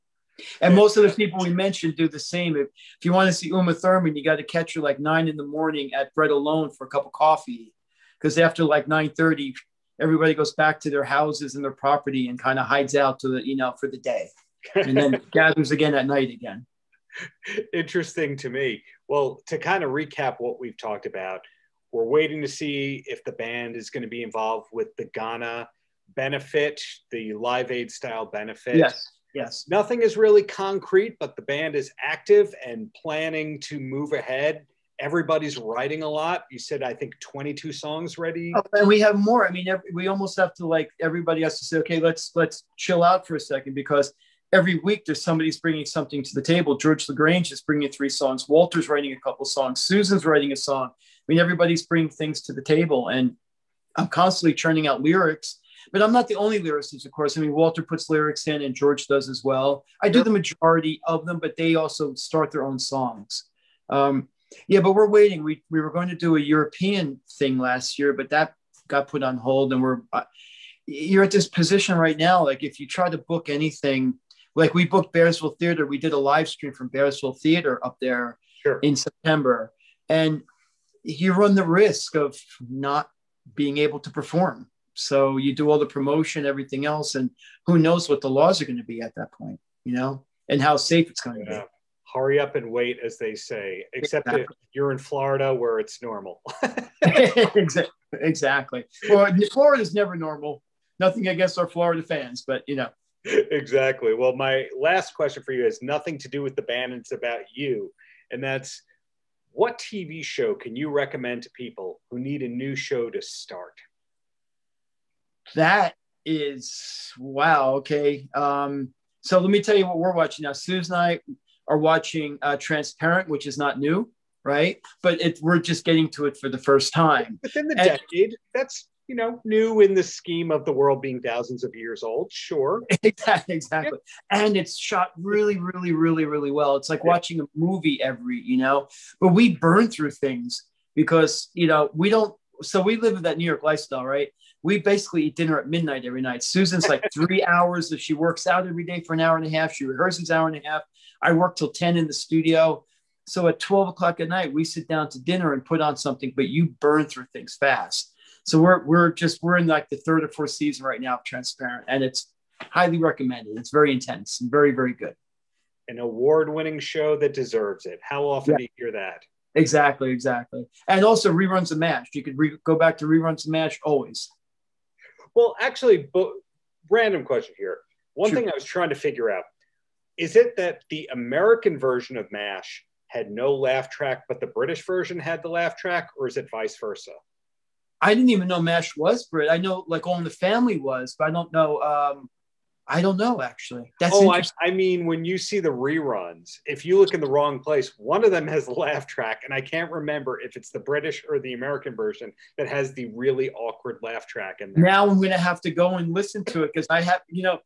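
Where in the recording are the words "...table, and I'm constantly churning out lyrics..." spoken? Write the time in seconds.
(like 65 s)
52 s.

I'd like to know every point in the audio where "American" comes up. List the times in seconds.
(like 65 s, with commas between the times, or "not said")
181 s, 201 s.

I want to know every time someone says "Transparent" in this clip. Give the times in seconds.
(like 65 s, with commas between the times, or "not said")
122 s, 161 s.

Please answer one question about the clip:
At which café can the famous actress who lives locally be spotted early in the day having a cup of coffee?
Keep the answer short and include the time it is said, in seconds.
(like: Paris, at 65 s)
Bread Alone, at 6 s.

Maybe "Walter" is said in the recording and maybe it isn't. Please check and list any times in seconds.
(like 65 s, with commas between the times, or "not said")
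48 s, 57 s.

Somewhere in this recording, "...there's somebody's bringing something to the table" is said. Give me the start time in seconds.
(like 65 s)
45 s.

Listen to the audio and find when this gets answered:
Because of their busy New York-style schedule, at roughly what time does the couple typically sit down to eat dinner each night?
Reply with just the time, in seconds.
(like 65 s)
145 s.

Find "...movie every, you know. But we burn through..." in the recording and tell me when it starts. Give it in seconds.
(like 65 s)
137 s.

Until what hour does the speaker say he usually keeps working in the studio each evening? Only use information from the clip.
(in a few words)
10.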